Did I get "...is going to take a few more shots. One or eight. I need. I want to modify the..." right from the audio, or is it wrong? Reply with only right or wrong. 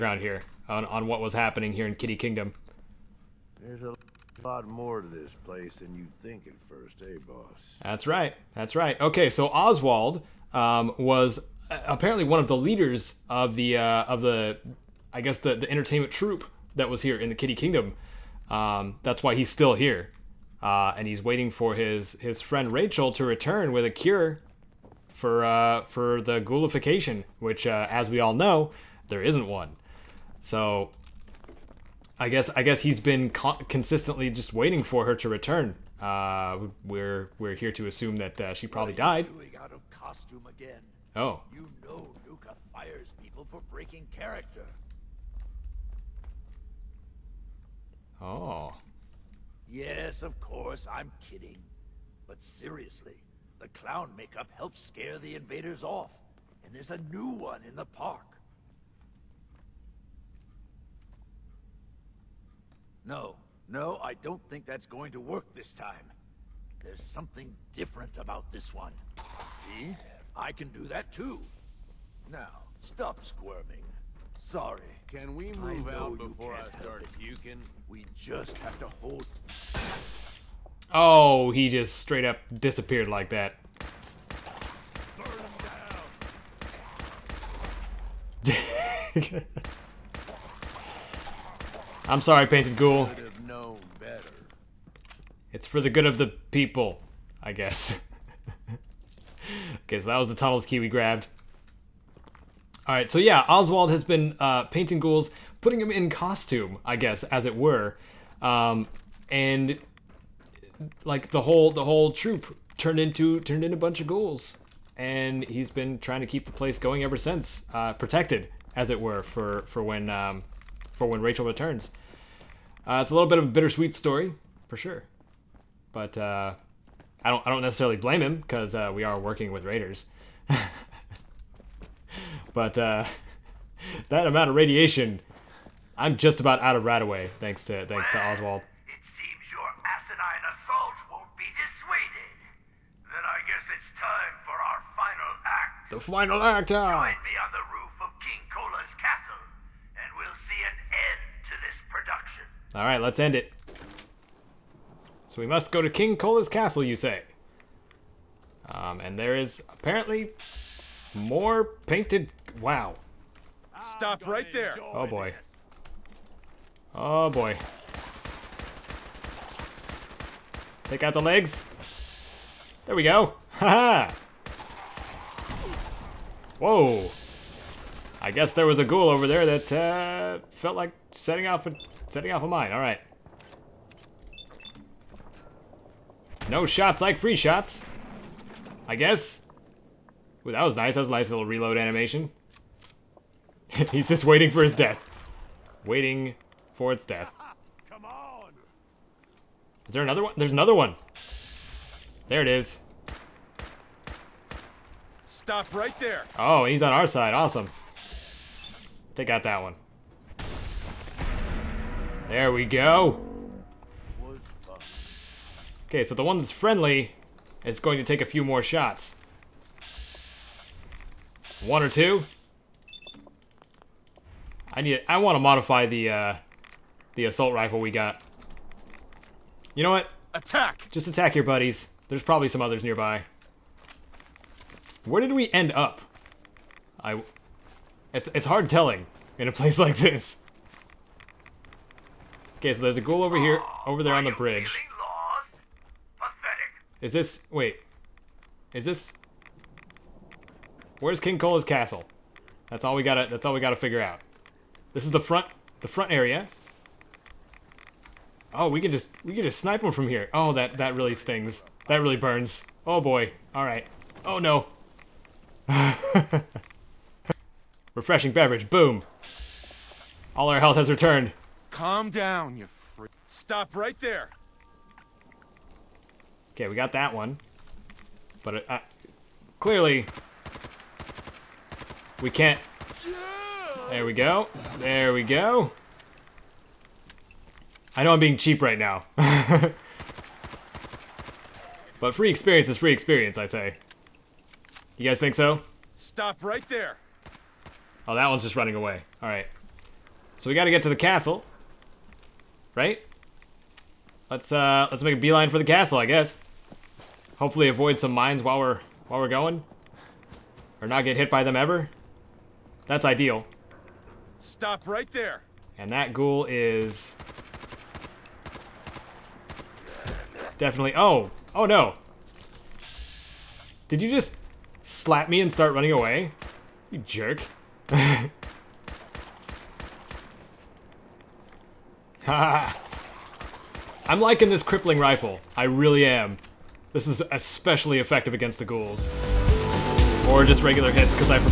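wrong.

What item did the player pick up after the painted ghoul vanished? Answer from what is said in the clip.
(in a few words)
tunnels key.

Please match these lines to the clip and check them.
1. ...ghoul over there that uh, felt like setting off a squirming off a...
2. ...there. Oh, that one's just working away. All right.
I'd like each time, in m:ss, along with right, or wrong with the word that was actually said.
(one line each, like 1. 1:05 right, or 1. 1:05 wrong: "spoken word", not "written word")
1. 2:58 wrong: "setting", not "squirming"
2. 4:56 wrong: "running", not "working".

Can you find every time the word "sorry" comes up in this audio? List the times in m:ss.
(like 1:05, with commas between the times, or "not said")
1:14, 1:32.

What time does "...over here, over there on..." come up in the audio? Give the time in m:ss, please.
4:03.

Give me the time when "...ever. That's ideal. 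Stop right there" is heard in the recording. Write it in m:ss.
5:11.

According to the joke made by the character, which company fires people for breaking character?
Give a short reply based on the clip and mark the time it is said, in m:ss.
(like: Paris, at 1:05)
Nuka, at 0:42.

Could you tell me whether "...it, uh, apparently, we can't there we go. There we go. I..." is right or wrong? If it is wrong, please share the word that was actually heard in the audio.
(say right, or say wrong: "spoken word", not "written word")
wrong: "clearly", not "apparently".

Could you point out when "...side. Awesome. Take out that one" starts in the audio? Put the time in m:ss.
3:27.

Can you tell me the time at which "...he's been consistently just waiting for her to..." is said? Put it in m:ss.
0:32.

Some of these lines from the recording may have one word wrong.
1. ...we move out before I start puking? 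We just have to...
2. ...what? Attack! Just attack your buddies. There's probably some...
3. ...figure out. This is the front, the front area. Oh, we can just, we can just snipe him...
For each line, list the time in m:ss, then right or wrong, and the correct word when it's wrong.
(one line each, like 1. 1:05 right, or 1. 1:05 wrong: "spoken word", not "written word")
1. 1:15 right
2. 3:49 right
3. 4:13 right.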